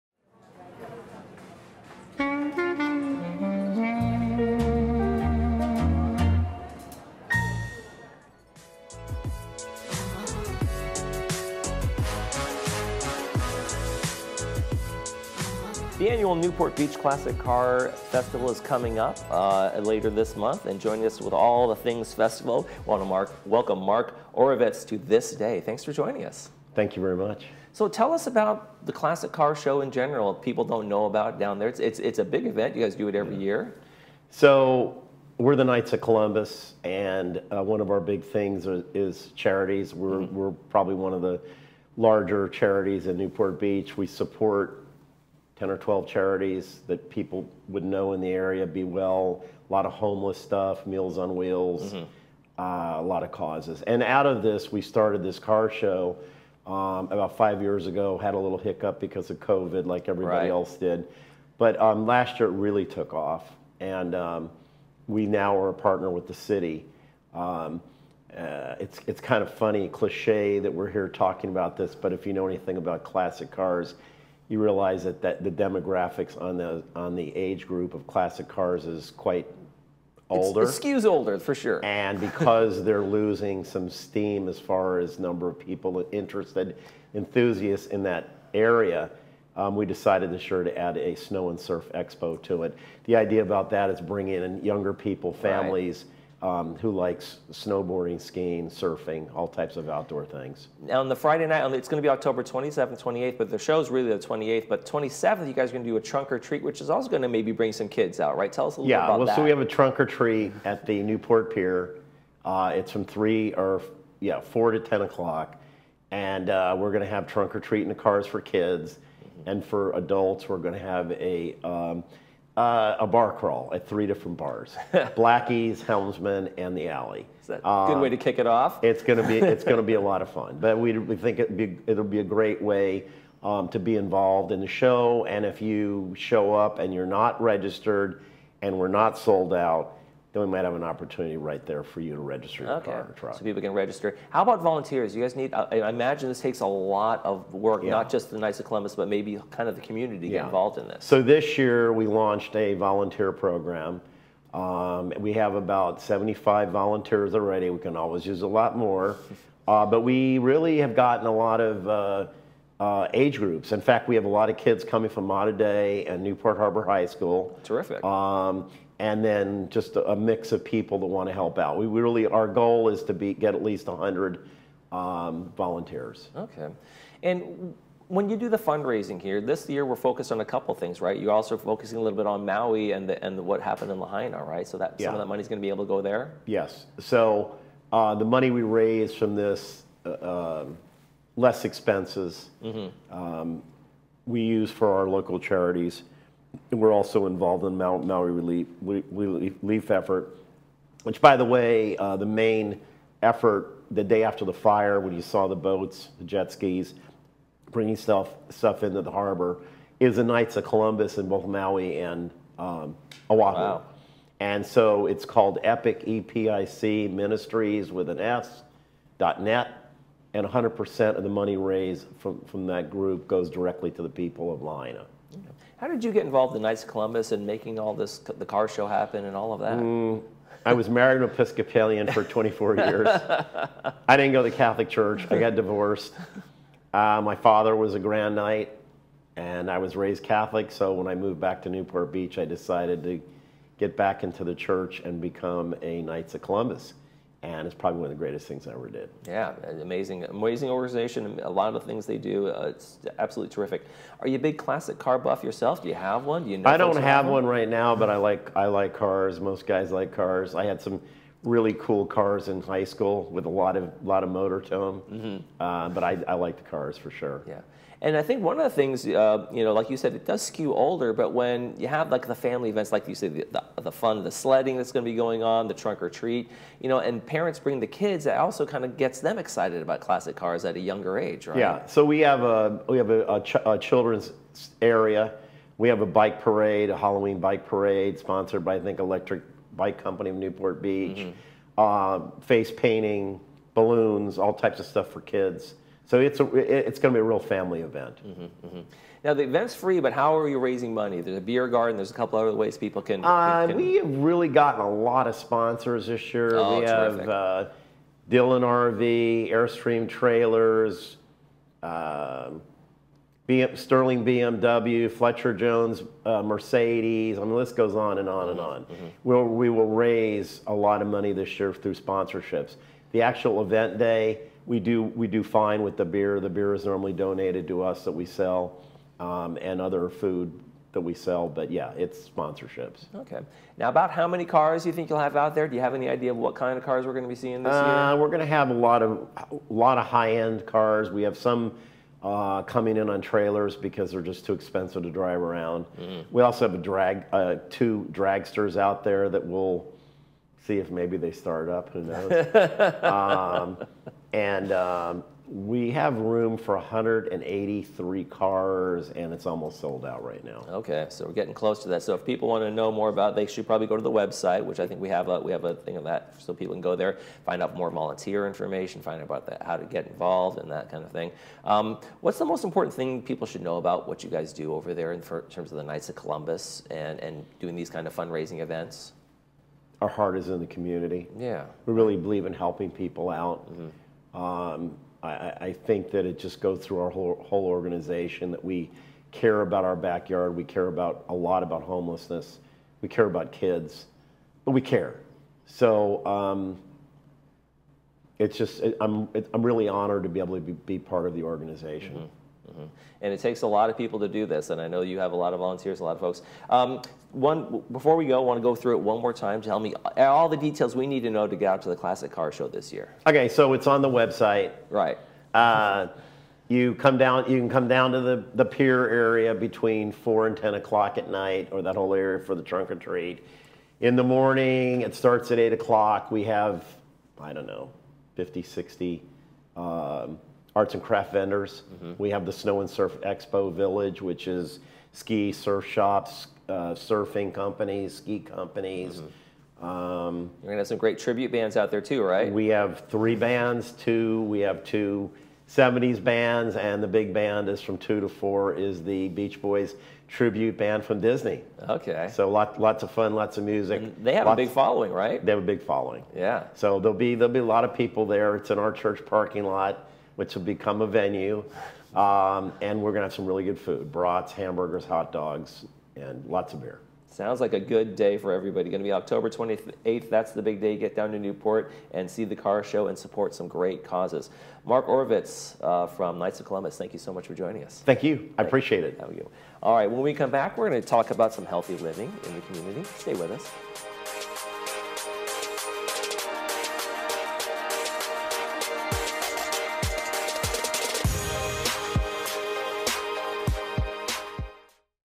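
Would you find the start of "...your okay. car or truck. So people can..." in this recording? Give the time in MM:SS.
02:22.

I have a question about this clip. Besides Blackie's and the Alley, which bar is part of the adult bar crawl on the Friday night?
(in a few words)
Helmsman.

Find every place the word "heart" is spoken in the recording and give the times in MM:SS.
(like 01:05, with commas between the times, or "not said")
06:20.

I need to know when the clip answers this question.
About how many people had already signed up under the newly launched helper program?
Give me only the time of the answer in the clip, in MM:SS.
02:36.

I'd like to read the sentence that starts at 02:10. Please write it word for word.
But we, we think it be, it'll be a great way um, to be involved in the show.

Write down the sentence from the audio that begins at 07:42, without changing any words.
Um, and we're going to have some really good food brats, hamburgers, hot dogs, and lots of beer.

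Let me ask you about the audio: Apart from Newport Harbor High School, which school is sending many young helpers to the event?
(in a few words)
Mater Dei.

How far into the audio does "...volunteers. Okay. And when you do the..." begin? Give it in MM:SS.
02:55.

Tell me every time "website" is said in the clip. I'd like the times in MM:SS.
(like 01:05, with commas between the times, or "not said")
06:04, 06:54.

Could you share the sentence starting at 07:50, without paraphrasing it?
Get down to Newport and see the car show and support some great causes.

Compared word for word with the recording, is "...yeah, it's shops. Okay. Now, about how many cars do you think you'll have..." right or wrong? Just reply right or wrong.
wrong.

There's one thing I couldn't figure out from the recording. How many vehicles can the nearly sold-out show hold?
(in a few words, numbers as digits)
183.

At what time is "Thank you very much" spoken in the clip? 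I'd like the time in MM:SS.
00:26.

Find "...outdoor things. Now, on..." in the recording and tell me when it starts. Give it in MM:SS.
01:39.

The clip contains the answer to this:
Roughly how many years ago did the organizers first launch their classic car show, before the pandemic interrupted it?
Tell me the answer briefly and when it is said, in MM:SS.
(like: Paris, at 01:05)
5 years, at 00:57.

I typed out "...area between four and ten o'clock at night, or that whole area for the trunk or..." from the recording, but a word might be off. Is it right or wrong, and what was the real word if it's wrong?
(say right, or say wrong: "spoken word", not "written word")
right.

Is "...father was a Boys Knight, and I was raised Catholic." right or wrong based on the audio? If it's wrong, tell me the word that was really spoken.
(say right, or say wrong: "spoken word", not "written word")
wrong: "Grand", not "Boys".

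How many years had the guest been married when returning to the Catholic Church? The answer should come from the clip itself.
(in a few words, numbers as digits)
24 years.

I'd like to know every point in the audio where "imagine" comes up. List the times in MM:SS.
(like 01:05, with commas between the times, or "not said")
02:25.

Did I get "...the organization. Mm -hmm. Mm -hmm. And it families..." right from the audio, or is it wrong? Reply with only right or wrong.
wrong.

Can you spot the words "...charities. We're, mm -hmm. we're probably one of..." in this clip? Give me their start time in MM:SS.
00:39.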